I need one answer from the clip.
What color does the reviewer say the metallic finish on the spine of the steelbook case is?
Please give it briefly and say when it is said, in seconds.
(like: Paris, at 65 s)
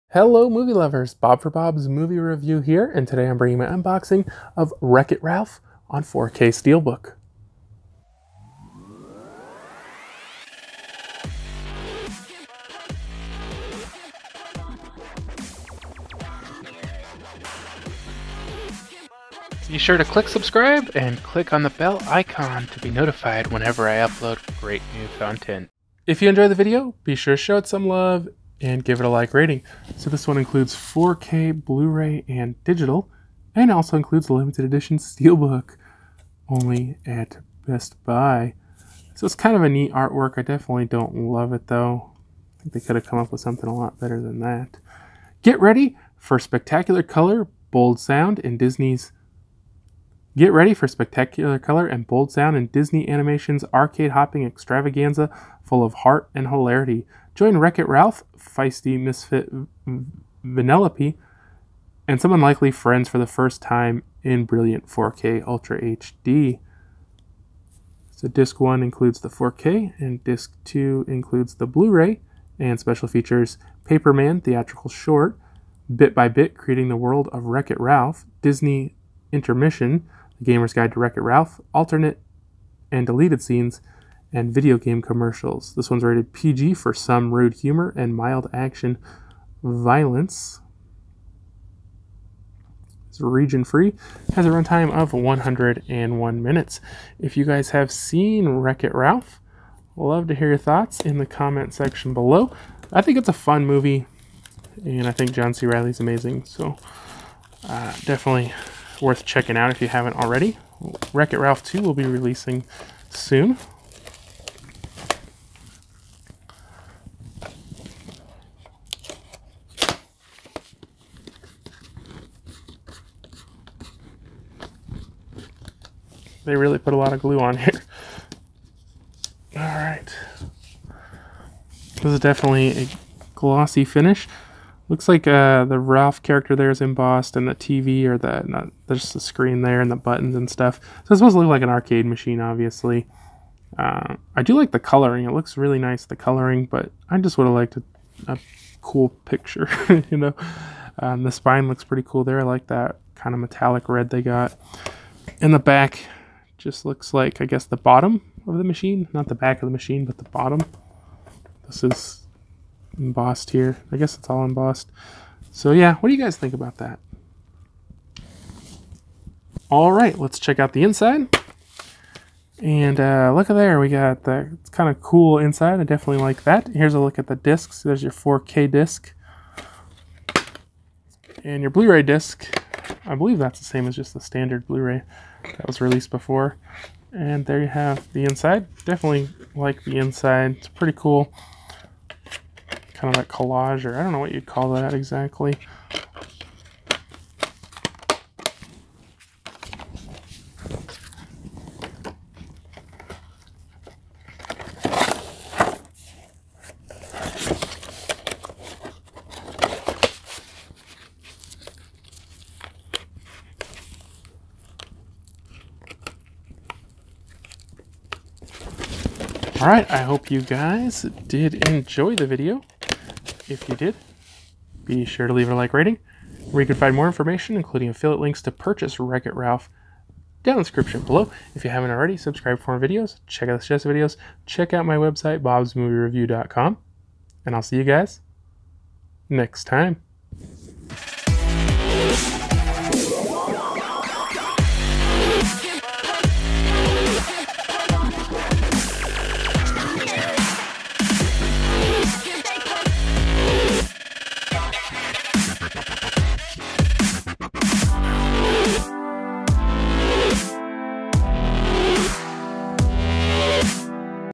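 Red, at 153 s.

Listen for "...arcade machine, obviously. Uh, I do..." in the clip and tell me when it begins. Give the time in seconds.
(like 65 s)
141 s.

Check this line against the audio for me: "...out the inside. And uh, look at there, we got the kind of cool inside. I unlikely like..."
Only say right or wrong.
wrong.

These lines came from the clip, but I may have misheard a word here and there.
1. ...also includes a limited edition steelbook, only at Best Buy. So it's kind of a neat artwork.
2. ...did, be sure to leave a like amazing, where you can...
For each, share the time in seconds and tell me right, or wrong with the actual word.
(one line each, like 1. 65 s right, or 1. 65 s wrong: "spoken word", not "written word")
1. 33 s right
2. 223 s wrong: "rating", not "amazing".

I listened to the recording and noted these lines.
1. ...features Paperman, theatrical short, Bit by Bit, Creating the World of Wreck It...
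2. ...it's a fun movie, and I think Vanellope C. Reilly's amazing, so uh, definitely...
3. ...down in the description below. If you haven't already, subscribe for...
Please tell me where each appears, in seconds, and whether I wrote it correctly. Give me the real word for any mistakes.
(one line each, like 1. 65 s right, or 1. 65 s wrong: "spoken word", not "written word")
1. 73 s right
2. 103 s wrong: "John", not "Vanellope"
3. 230 s right.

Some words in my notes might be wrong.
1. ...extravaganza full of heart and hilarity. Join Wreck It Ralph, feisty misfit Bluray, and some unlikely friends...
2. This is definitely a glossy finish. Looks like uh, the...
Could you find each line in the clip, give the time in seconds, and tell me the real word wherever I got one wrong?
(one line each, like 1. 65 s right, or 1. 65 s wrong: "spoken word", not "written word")
1. 54 s wrong: "Vanellope", not "Bluray"
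2. 131 s right.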